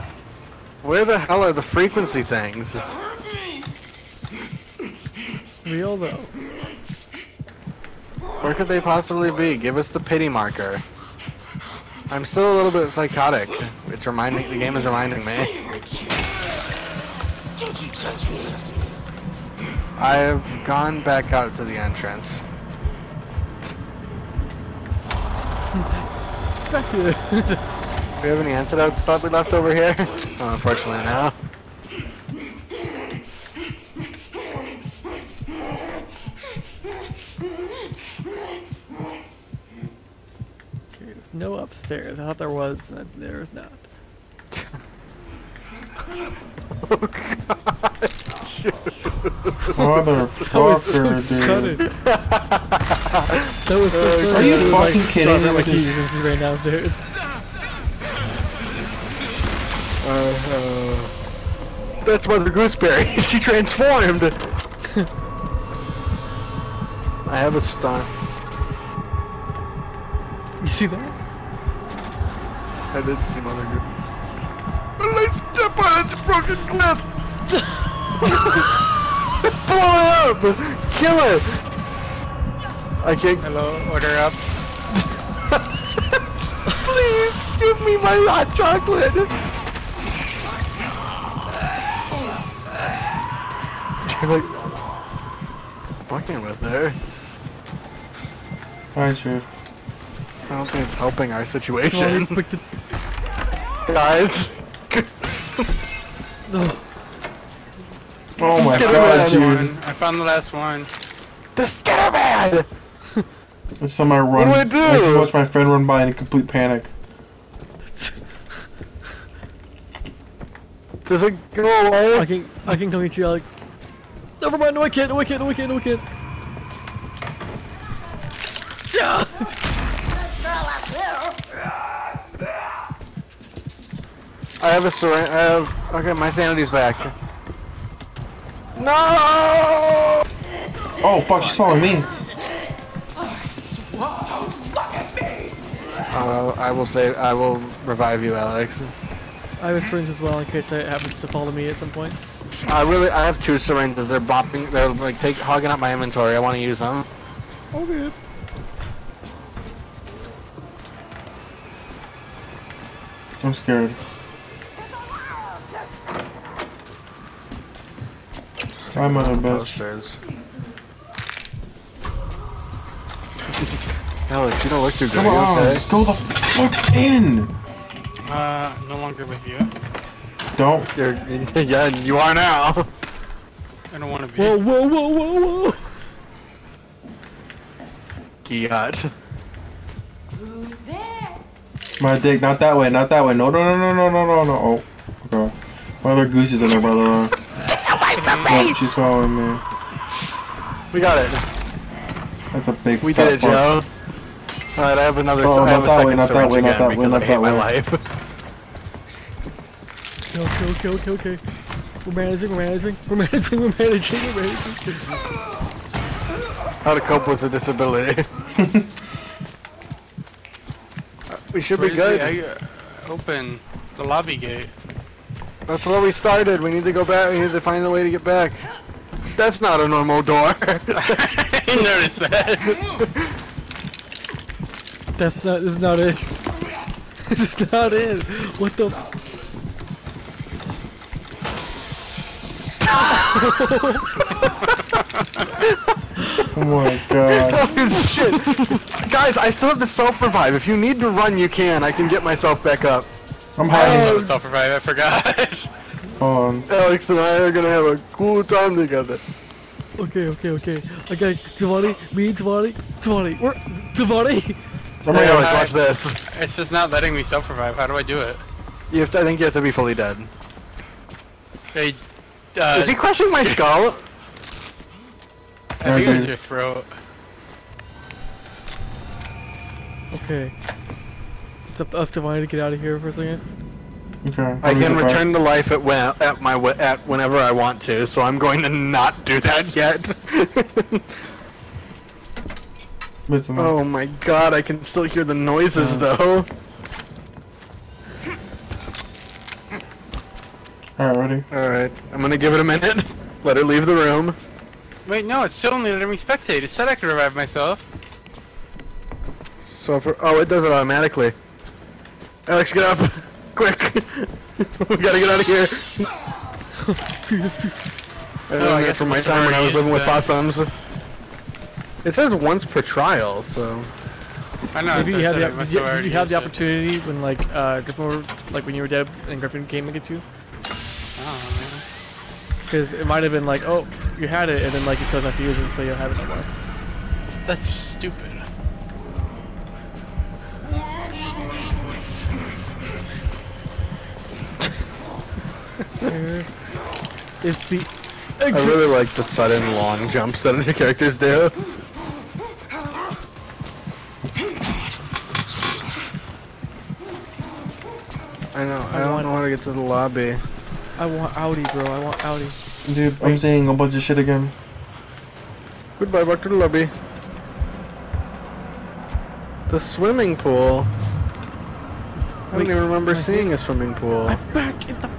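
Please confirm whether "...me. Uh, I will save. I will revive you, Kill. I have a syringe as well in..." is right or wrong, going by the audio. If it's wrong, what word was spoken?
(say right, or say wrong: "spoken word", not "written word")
wrong: "Alex", not "Kill".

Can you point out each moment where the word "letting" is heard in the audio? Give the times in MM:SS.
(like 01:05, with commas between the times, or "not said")
04:26, 05:05.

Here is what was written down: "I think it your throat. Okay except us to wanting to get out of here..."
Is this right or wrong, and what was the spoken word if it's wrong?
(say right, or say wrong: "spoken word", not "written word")
right.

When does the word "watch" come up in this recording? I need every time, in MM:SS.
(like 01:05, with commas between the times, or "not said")
01:55, 04:25.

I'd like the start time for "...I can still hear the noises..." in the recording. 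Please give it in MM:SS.
04:54.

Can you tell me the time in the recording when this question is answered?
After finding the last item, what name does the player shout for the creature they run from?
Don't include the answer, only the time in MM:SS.
01:51.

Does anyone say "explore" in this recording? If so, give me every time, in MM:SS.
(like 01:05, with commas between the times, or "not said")
not said.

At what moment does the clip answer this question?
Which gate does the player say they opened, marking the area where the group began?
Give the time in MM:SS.
03:44.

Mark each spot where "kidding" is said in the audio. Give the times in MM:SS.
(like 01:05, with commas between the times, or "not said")
00:55.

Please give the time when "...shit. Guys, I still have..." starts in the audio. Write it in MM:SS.
04:08.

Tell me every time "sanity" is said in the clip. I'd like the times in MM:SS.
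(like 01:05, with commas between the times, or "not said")
02:16.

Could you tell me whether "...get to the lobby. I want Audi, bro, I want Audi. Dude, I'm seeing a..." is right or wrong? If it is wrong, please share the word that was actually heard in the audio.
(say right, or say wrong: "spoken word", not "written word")
right.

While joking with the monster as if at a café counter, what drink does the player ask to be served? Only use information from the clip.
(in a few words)
hot chocolate.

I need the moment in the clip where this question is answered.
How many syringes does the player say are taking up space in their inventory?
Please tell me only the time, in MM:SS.
02:33.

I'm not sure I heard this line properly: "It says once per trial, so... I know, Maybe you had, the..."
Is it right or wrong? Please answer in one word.
right.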